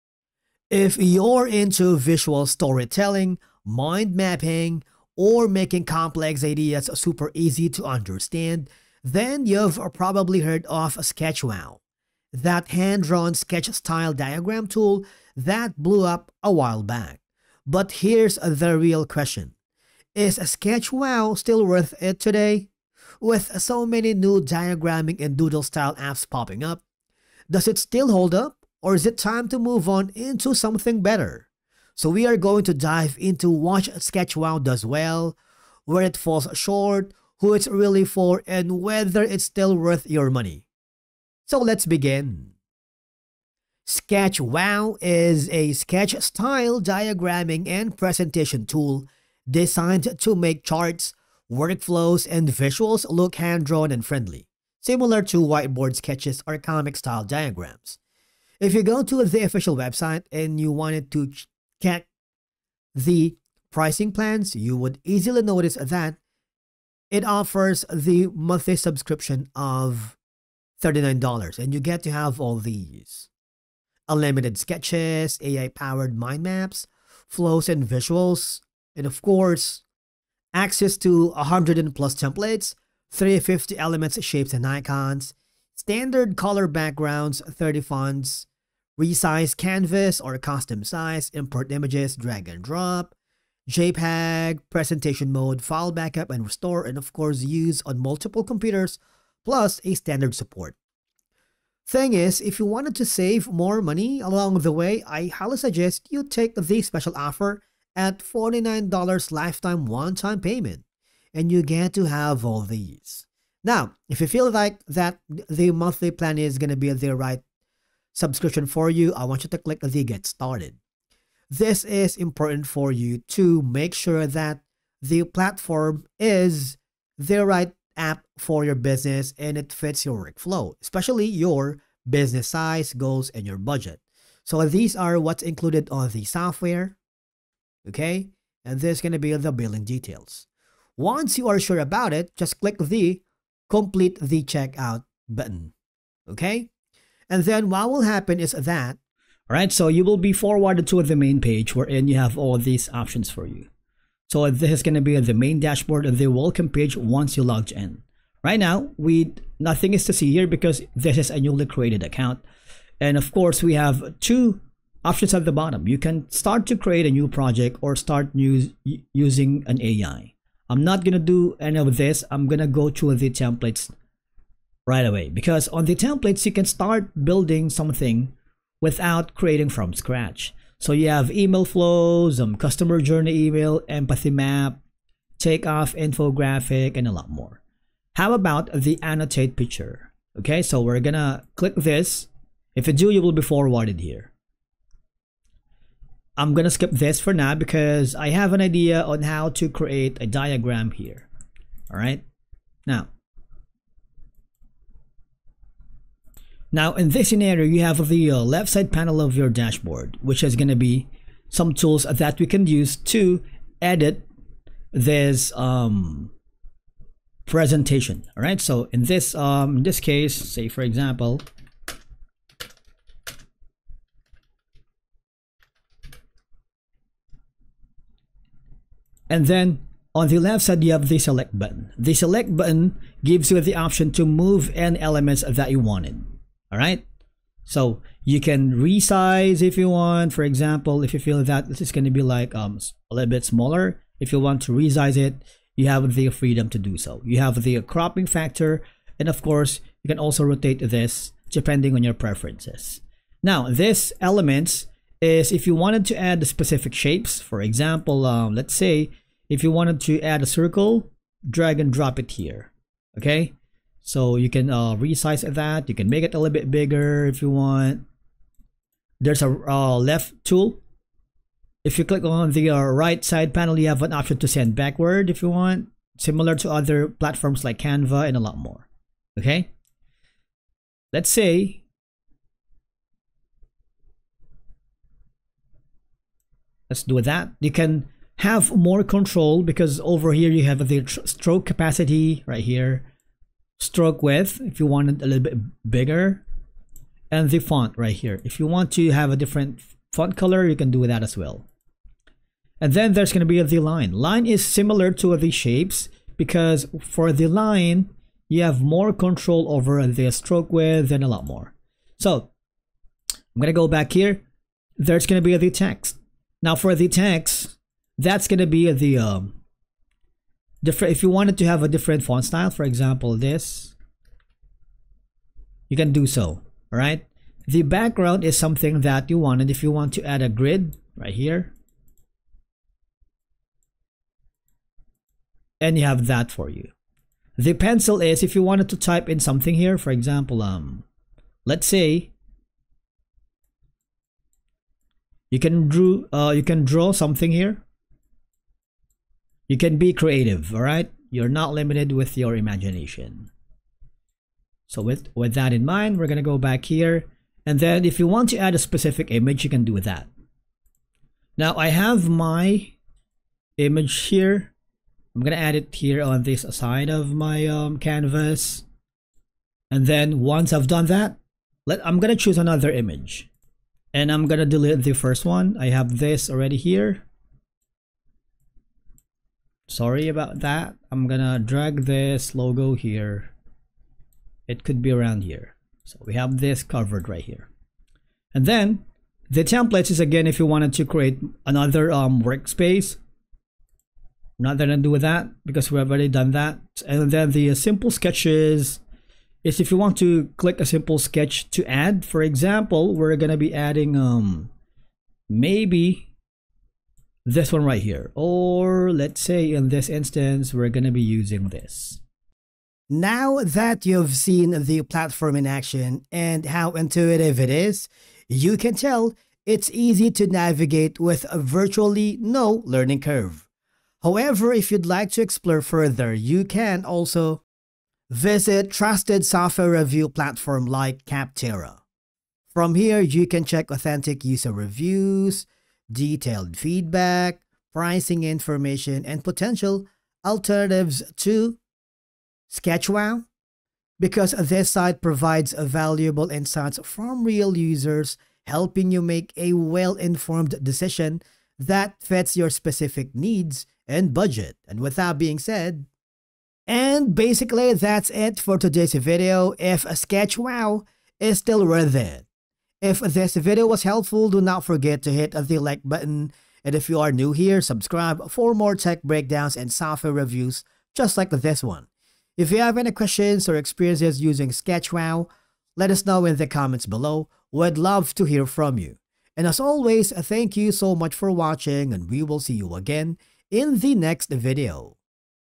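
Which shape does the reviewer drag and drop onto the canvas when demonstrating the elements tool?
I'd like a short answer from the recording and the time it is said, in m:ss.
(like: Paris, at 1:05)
Circle, at 4:20.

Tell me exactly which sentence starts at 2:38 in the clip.
Right now, we nothing is to see here because this is a newly created account.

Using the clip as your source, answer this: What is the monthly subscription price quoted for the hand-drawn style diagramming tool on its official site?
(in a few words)
$39.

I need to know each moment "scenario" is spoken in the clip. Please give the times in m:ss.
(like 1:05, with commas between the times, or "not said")
3:27.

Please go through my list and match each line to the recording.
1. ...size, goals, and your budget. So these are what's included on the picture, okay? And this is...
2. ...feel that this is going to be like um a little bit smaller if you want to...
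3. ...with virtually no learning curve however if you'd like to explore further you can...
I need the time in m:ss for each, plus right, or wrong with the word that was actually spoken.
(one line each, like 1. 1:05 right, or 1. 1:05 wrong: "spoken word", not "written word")
1. 2:12 wrong: "software", not "picture"
2. 4:01 right
3. 7:01 right.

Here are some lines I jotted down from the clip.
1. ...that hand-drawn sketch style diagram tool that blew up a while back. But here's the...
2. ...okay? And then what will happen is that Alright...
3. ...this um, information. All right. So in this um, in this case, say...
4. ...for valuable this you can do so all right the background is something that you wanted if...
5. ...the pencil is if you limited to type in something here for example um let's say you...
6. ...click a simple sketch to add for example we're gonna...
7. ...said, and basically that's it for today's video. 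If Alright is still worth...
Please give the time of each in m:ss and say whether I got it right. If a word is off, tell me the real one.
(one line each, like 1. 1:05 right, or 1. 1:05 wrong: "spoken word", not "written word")
1. 0:12 right
2. 2:26 right
3. 3:34 wrong: "presentation", not "information"
4. 5:22 wrong: "example", not "valuable"
5. 5:37 wrong: "wanted", not "limited"
6. 6:40 right
7. 7:35 wrong: "SketchWow", not "Alright".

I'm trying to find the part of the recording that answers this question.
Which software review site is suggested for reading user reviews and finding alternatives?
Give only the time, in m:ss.
7:11.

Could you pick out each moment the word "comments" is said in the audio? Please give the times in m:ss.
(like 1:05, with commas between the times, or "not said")
7:56.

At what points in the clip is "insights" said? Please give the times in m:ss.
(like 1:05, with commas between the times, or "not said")
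7:26.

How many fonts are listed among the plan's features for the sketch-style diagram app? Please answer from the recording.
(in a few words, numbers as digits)
30.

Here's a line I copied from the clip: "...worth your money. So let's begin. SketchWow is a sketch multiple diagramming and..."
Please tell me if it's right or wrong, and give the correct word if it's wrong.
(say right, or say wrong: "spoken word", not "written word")
wrong: "style", not "multiple".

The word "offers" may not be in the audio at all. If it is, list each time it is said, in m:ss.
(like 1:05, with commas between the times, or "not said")
1:07, 1:47.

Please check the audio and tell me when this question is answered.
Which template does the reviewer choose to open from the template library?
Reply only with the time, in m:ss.
3:09.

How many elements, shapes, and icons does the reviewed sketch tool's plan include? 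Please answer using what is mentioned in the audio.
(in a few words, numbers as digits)
350.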